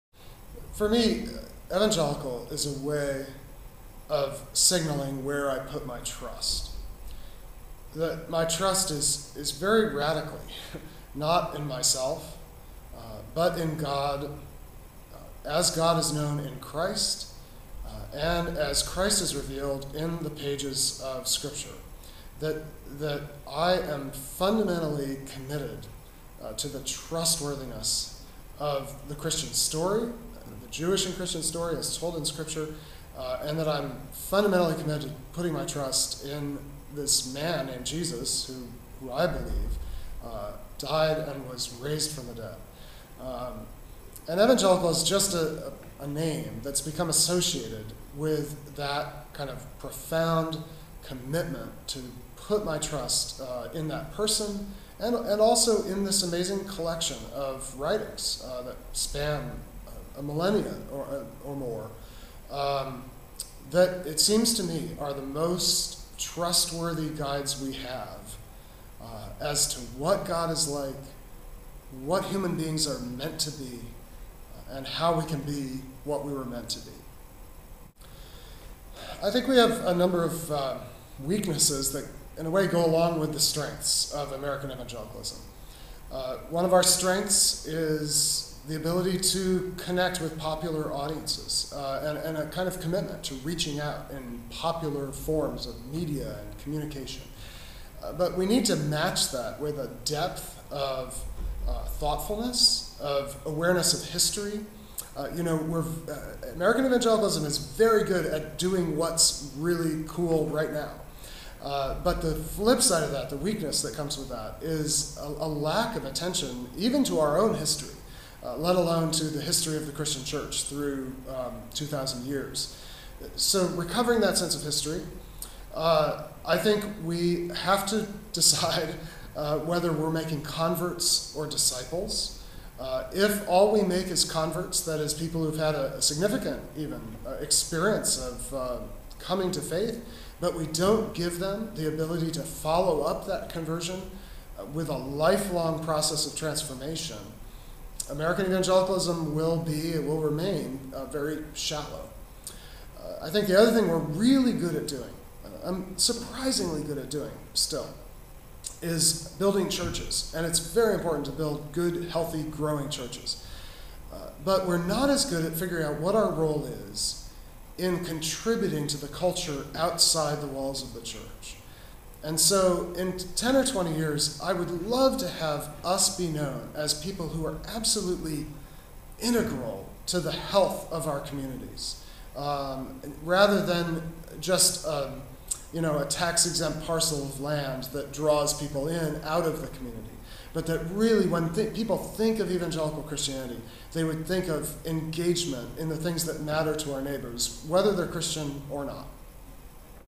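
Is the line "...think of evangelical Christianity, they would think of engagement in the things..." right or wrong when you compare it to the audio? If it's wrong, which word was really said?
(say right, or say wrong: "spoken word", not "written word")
right.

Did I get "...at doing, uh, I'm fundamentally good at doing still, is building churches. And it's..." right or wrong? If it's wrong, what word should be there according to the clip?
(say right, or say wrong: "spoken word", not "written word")
wrong: "surprisingly", not "fundamentally".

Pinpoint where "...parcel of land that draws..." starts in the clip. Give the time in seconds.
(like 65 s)
186 s.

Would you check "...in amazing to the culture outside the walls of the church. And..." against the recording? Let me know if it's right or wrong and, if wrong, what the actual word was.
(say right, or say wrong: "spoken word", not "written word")
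wrong: "contributing", not "amazing".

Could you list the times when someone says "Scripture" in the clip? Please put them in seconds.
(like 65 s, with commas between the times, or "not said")
21 s, 32 s.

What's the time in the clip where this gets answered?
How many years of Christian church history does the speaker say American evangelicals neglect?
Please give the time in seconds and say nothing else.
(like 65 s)
121 s.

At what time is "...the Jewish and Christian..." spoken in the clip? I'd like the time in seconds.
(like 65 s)
30 s.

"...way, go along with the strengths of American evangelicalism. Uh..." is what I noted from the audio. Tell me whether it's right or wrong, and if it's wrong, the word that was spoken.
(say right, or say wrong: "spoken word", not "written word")
right.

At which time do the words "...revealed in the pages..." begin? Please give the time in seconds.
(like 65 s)
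19 s.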